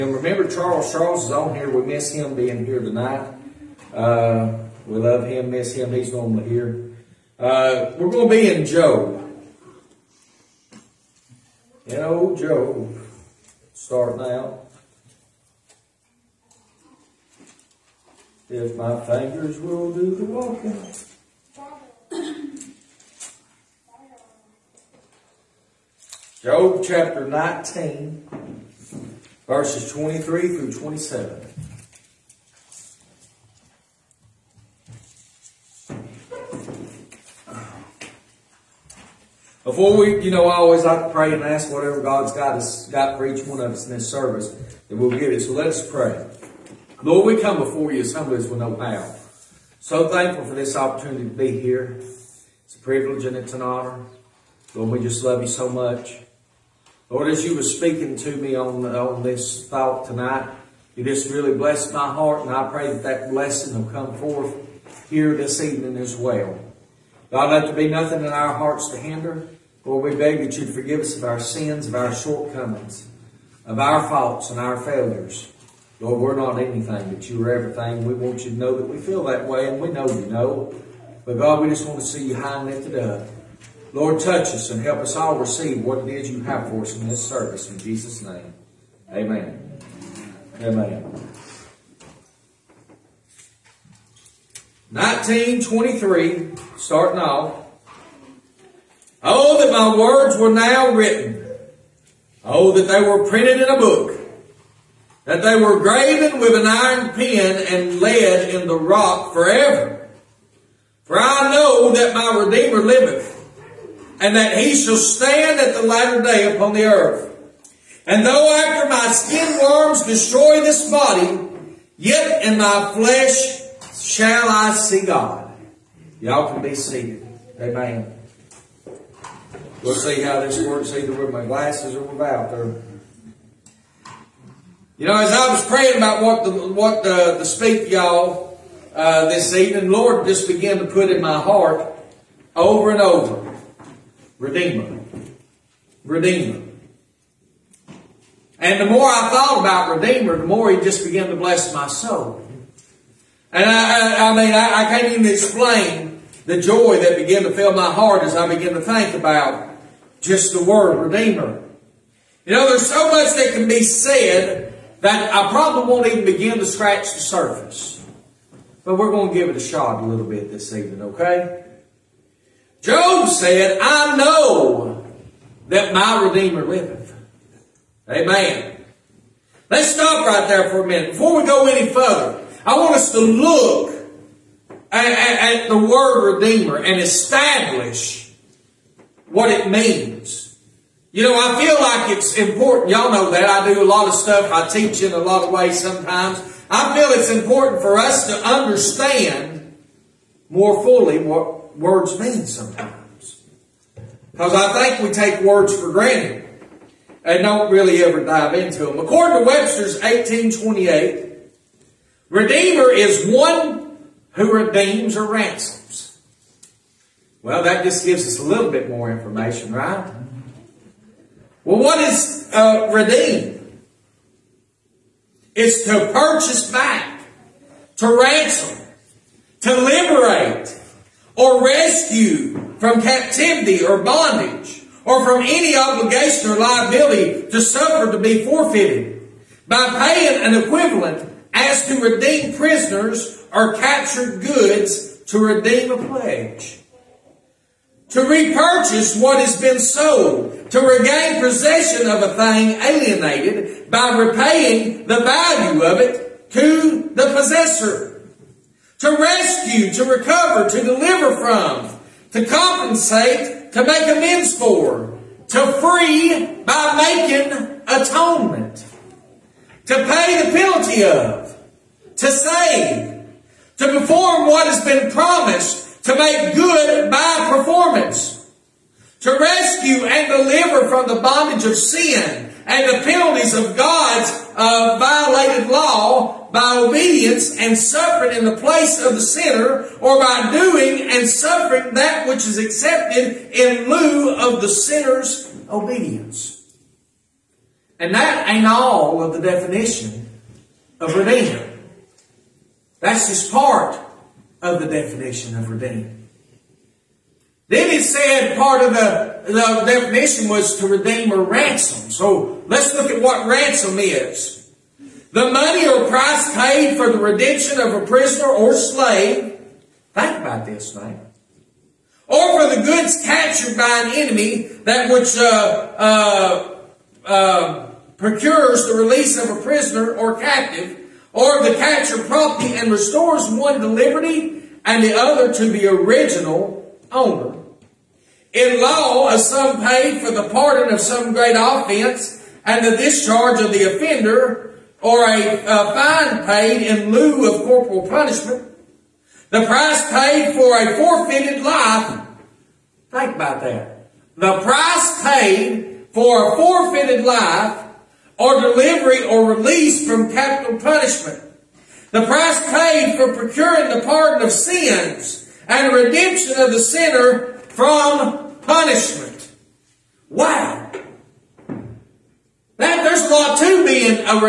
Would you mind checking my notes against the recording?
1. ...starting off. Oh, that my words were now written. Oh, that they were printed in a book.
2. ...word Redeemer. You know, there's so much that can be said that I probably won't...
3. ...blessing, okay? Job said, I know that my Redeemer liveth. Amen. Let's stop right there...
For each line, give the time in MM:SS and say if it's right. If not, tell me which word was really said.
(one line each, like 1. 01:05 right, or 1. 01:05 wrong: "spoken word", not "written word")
1. 01:36 right
2. 02:40 right
3. 02:50 wrong: "evening", not "blessing".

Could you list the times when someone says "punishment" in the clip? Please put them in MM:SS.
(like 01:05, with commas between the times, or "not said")
05:48, 06:00, 06:08.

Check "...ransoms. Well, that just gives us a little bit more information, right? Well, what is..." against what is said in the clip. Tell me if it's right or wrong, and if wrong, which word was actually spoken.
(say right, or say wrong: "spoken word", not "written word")
right.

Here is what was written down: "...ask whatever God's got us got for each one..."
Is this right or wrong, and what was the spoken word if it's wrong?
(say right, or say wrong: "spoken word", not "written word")
right.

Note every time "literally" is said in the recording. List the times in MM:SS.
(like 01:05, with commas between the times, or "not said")
not said.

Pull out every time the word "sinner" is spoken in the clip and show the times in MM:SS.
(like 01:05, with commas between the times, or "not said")
04:49, 04:54, 06:06.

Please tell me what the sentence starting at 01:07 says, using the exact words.
God, let there be nothing in our hearts to hinder.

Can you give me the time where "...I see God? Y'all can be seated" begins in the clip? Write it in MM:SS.
02:04.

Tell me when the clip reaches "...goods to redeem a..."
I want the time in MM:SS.
04:04.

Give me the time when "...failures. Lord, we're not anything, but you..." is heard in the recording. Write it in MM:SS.
01:14.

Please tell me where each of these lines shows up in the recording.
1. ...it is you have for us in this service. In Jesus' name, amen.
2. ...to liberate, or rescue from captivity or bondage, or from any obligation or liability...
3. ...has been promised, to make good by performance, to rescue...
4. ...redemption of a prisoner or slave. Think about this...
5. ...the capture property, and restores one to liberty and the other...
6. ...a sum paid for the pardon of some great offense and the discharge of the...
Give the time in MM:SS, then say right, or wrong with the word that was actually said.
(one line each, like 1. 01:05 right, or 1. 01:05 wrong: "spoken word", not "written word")
1. 01:26 right
2. 03:49 right
3. 04:34 right
4. 05:17 right
5. 05:31 right
6. 05:39 right.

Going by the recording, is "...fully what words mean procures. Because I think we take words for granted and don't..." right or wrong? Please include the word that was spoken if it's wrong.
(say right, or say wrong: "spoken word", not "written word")
wrong: "sometimes", not "procures".